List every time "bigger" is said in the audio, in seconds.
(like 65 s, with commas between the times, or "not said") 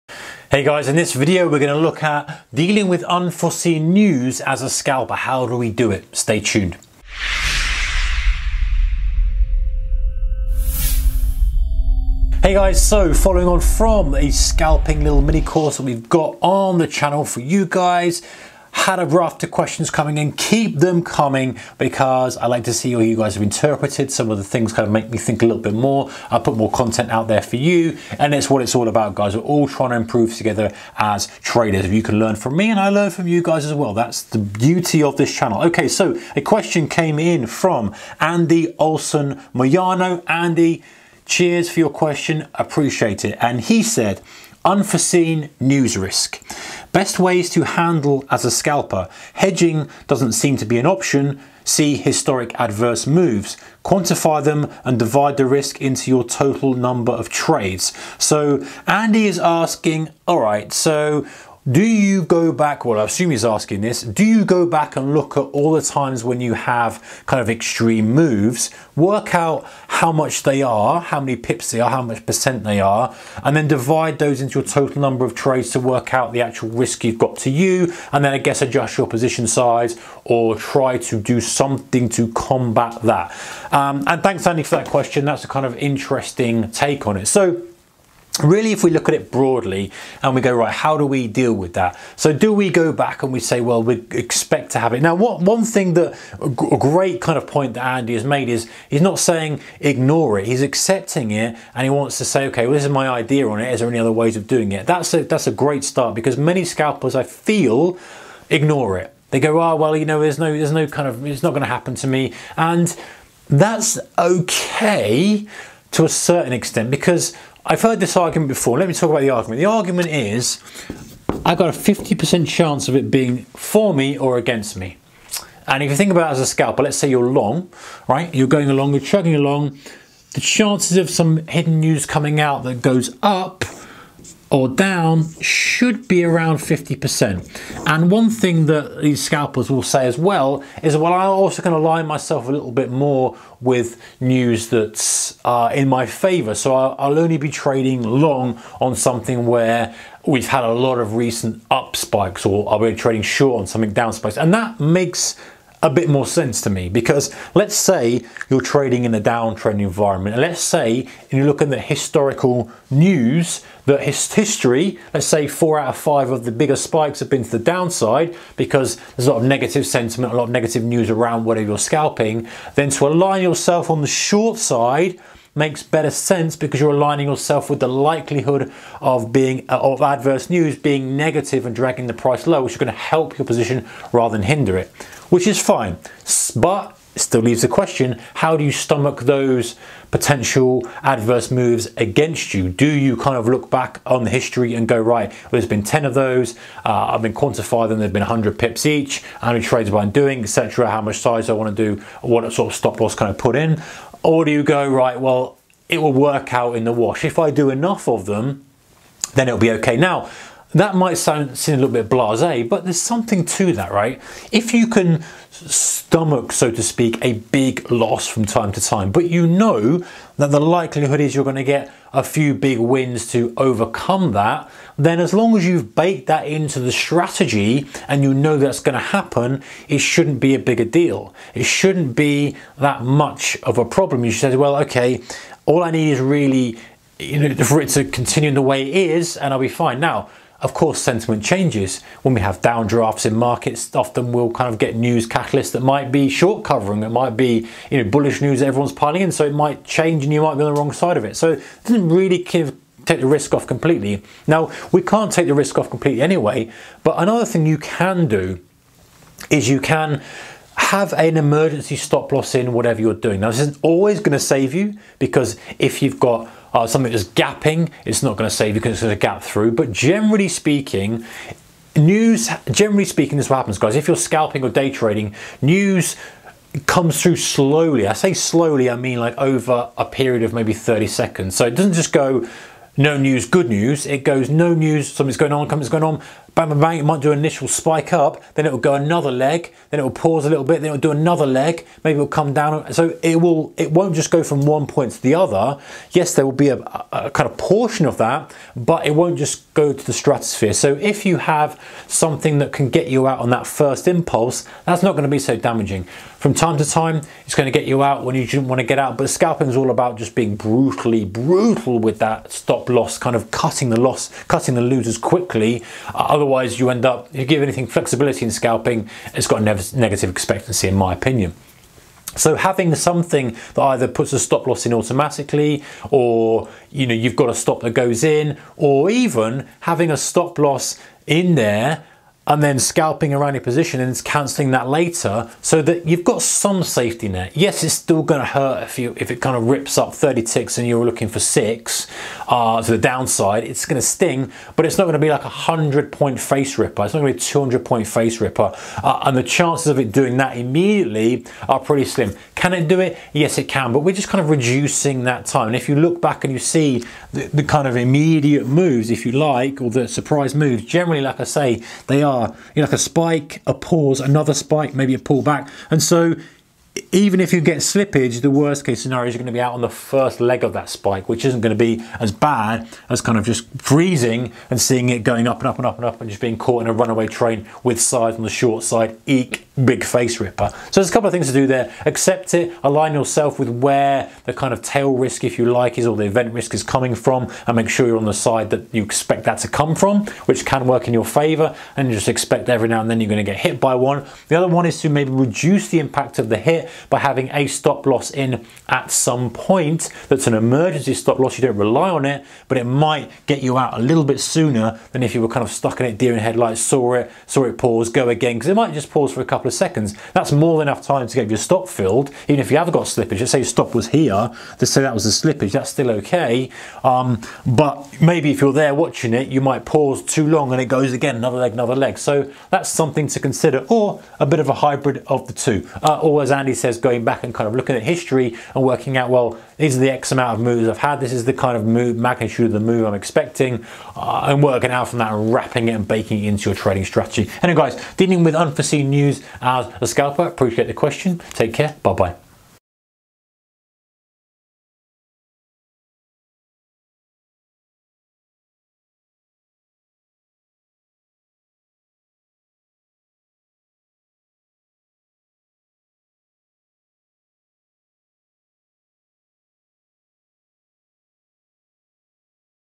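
166 s, 230 s.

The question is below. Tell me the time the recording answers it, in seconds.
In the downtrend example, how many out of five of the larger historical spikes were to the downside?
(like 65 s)
165 s.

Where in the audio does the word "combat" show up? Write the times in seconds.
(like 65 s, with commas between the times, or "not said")
82 s.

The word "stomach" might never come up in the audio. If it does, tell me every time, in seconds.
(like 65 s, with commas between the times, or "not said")
188 s, 215 s.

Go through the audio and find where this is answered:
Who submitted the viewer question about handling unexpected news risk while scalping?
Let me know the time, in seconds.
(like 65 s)
38 s.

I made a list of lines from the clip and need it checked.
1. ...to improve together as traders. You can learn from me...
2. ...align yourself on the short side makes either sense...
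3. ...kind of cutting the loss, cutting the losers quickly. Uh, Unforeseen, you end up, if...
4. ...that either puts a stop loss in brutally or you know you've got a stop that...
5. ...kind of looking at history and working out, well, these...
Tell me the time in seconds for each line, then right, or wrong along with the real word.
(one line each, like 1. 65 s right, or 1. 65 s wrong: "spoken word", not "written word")
1. 29 s right
2. 173 s wrong: "better", not "either"
3. 313 s wrong: "Otherwise", not "Unforeseen"
4. 323 s wrong: "automatically", not "brutally"
5. 427 s right.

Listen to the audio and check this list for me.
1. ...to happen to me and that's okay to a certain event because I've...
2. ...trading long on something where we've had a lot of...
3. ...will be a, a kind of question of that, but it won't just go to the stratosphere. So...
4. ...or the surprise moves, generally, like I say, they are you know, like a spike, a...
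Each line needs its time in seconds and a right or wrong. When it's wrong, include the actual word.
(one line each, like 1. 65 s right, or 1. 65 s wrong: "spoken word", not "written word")
1. 111 s wrong: "extent", not "event"
2. 147 s right
3. 296 s wrong: "portion", not "question"
4. 359 s right.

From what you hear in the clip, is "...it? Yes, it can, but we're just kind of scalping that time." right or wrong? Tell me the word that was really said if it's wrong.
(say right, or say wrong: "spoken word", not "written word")
wrong: "reducing", not "scalping".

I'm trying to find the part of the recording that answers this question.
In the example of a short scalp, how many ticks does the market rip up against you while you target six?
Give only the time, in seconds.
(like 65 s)
340 s.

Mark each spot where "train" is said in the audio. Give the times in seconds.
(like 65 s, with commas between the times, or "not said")
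377 s.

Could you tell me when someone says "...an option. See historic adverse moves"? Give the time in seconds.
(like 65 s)
50 s.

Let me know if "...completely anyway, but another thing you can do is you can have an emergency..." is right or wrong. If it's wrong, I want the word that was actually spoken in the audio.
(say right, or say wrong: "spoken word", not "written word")
right.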